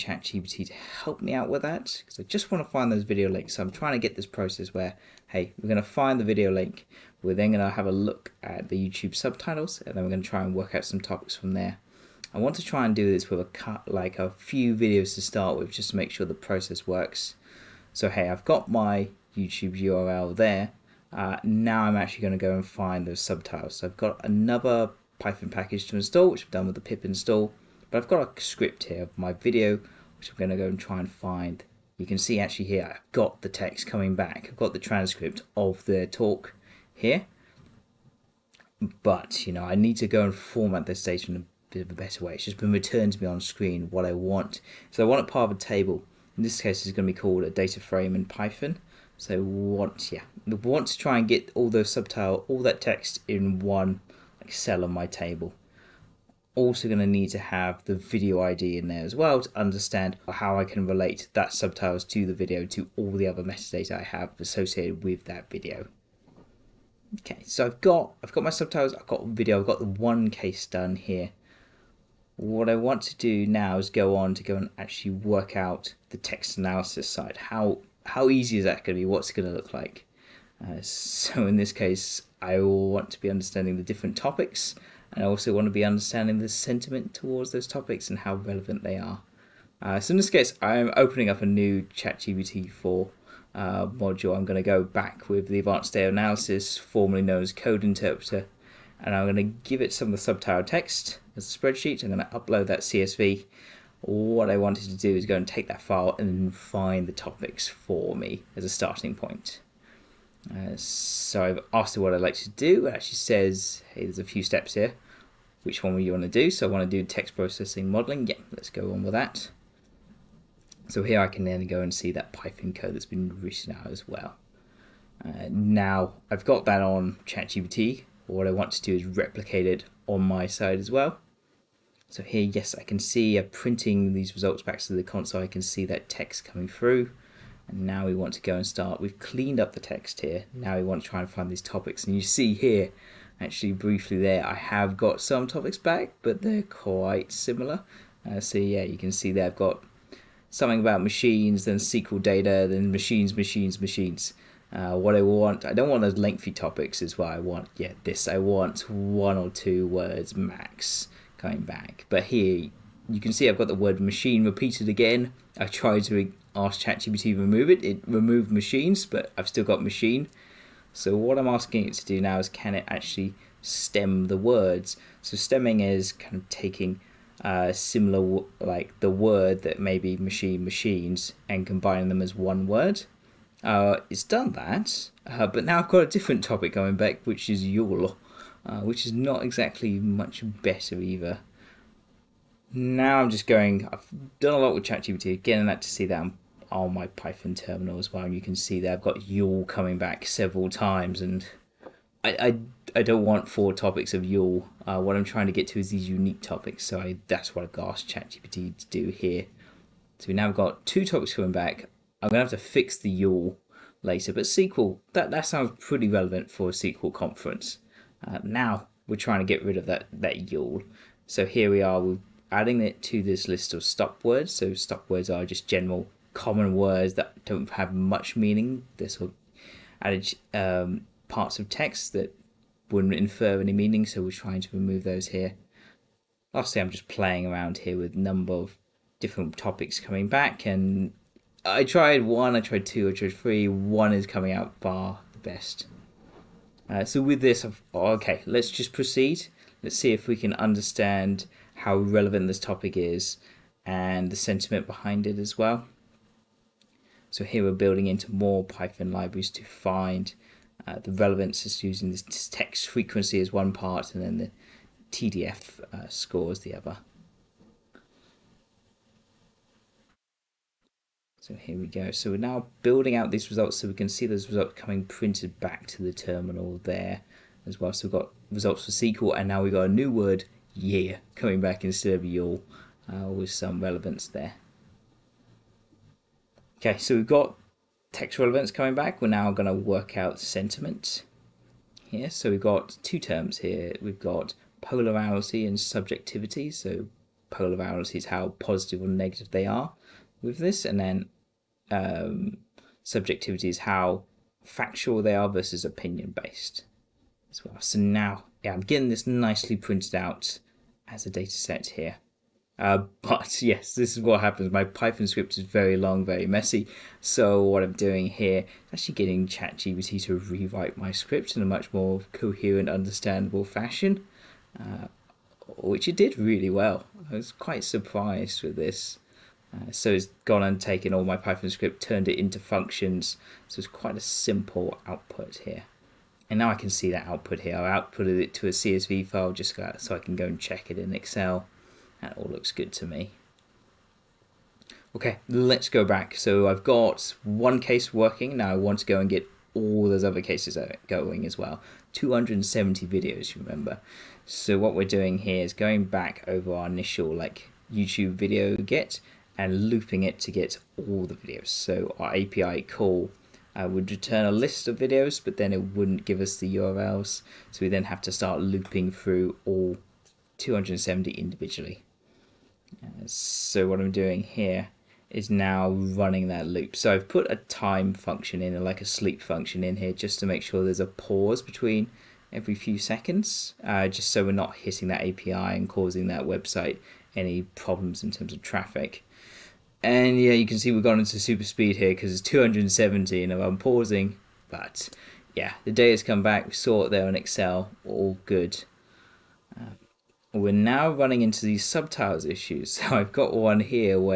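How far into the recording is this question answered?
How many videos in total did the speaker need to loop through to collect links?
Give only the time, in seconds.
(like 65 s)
352 s.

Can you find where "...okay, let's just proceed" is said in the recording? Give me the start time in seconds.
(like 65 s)
248 s.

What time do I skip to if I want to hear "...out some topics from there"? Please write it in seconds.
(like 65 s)
10 s.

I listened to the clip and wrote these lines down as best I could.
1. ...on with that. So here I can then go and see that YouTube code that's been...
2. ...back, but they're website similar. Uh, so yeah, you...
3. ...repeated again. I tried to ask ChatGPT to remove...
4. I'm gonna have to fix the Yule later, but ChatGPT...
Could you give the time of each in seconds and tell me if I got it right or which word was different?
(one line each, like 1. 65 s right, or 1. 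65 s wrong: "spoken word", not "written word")
1. 118 s wrong: "Python", not "YouTube"
2. 145 s wrong: "quite", not "website"
3. 164 s right
4. 212 s wrong: "SQL", not "ChatGPT".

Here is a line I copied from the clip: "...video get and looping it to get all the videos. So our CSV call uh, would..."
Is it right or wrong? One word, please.
wrong.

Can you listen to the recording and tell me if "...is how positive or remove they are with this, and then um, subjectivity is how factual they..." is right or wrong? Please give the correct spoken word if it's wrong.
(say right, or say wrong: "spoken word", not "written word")
wrong: "negative", not "remove".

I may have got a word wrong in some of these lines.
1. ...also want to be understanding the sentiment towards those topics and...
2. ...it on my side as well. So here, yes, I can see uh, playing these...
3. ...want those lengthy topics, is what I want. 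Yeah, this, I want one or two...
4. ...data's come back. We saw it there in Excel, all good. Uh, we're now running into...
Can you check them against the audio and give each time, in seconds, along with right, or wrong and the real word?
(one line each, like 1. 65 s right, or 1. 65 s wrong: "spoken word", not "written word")
1. 85 s right
2. 129 s wrong: "printing", not "playing"
3. 155 s right
4. 395 s right.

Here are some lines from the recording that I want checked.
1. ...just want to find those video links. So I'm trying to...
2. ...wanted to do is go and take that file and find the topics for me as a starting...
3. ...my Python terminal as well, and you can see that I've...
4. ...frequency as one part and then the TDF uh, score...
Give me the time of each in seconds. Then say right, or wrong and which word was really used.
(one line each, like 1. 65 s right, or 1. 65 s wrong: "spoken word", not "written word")
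1. 2 s right
2. 104 s right
3. 196 s right
4. 262 s right.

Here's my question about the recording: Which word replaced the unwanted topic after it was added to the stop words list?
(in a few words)
year.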